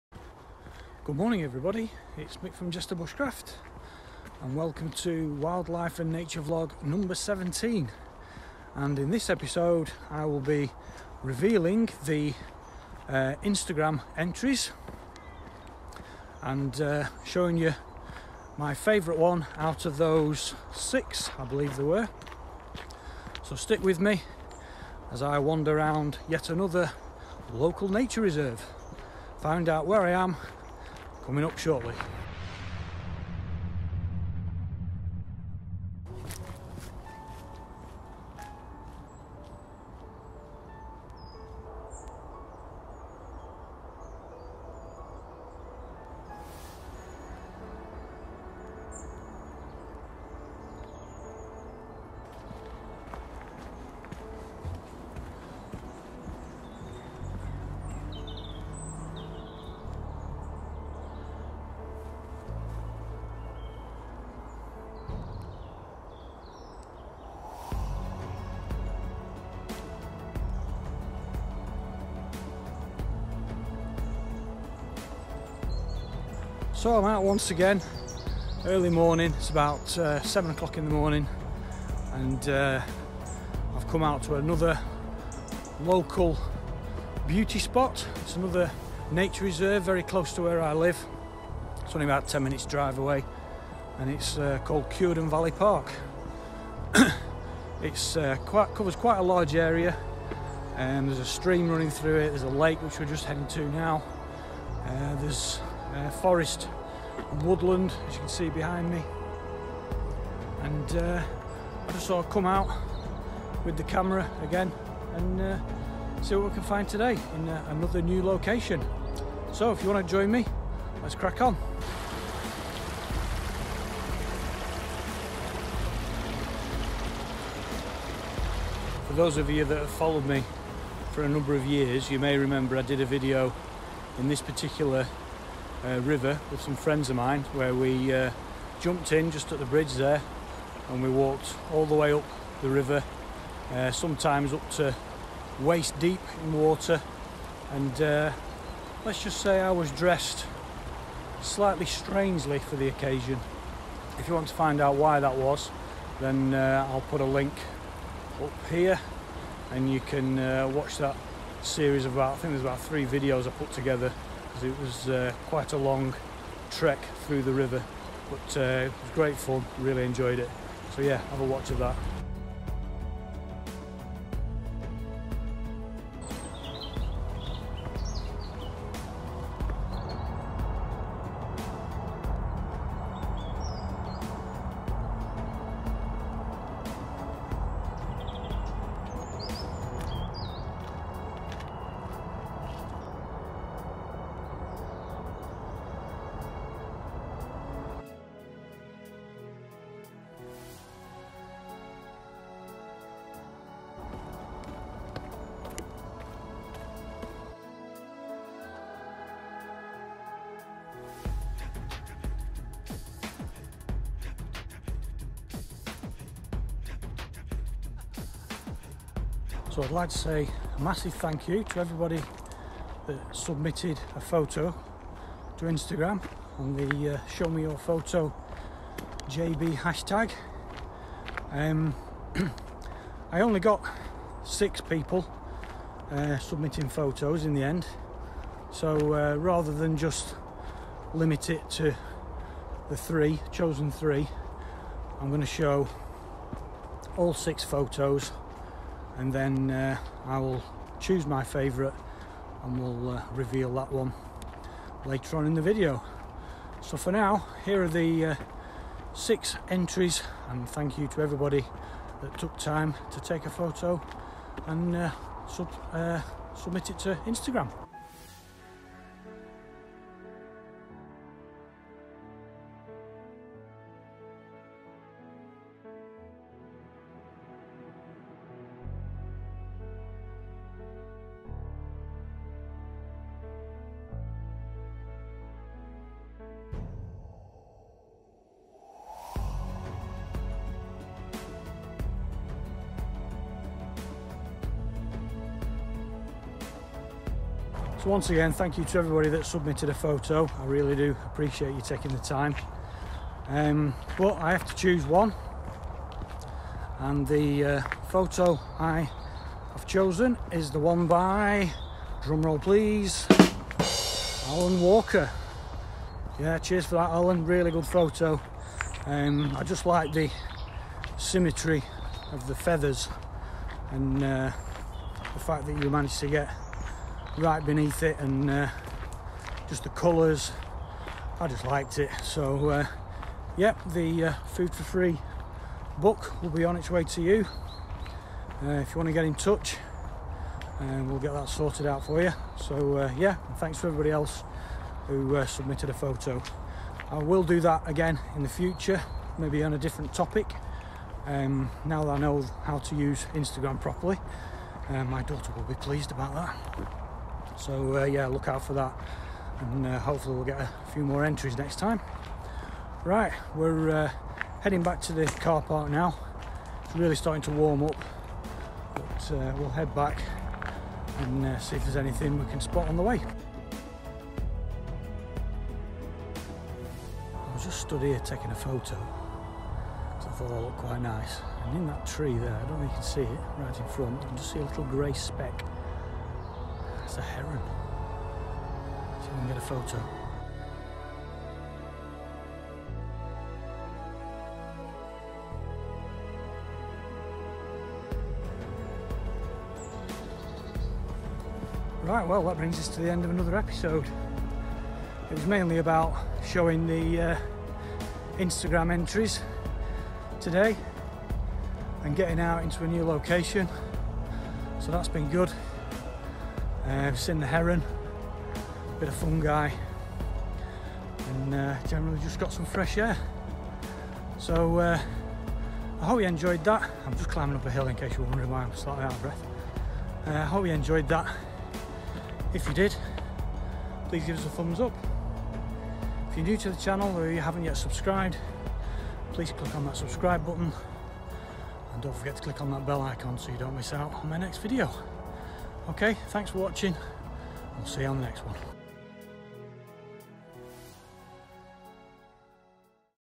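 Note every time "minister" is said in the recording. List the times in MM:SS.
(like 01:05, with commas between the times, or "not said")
not said.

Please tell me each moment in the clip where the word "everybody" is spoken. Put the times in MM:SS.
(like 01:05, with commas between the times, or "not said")
00:01, 03:41, 04:21, 04:58, 05:43.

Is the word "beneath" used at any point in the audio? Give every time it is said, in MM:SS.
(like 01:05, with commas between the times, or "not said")
05:27.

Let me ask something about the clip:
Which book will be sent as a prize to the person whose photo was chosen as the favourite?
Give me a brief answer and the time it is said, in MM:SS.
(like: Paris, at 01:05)
Food for Free, at 05:34.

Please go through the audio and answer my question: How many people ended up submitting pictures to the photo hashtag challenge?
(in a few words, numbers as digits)
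6.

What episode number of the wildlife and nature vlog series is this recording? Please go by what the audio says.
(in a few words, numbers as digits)
17.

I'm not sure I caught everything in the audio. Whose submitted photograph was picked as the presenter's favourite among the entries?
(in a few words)
Alan Walker.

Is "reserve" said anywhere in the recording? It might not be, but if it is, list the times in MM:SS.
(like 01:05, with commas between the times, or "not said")
00:28, 01:29.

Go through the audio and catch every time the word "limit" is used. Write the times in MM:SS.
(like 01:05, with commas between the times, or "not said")
04:01.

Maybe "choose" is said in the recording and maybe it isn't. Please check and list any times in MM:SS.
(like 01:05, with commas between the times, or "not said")
04:10, 05:04.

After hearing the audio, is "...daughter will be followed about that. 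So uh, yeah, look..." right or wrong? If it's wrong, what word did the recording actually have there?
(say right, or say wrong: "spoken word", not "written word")
wrong: "pleased", not "followed".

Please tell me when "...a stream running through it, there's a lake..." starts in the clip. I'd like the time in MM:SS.
01:41.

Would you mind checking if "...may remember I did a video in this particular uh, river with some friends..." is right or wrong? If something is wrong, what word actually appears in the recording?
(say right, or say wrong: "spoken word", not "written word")
right.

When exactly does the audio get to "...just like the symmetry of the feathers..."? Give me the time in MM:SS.
05:19.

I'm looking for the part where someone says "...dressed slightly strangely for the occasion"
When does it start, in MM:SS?
02:29.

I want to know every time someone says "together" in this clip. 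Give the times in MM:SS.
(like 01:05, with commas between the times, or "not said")
02:43.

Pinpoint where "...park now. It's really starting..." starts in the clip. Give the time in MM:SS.
06:05.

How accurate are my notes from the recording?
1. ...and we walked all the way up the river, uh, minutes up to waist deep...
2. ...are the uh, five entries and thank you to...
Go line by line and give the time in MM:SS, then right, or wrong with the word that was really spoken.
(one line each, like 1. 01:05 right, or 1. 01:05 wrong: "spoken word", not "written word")
1. 02:20 wrong: "sometimes", not "minutes"
2. 04:17 wrong: "six", not "five".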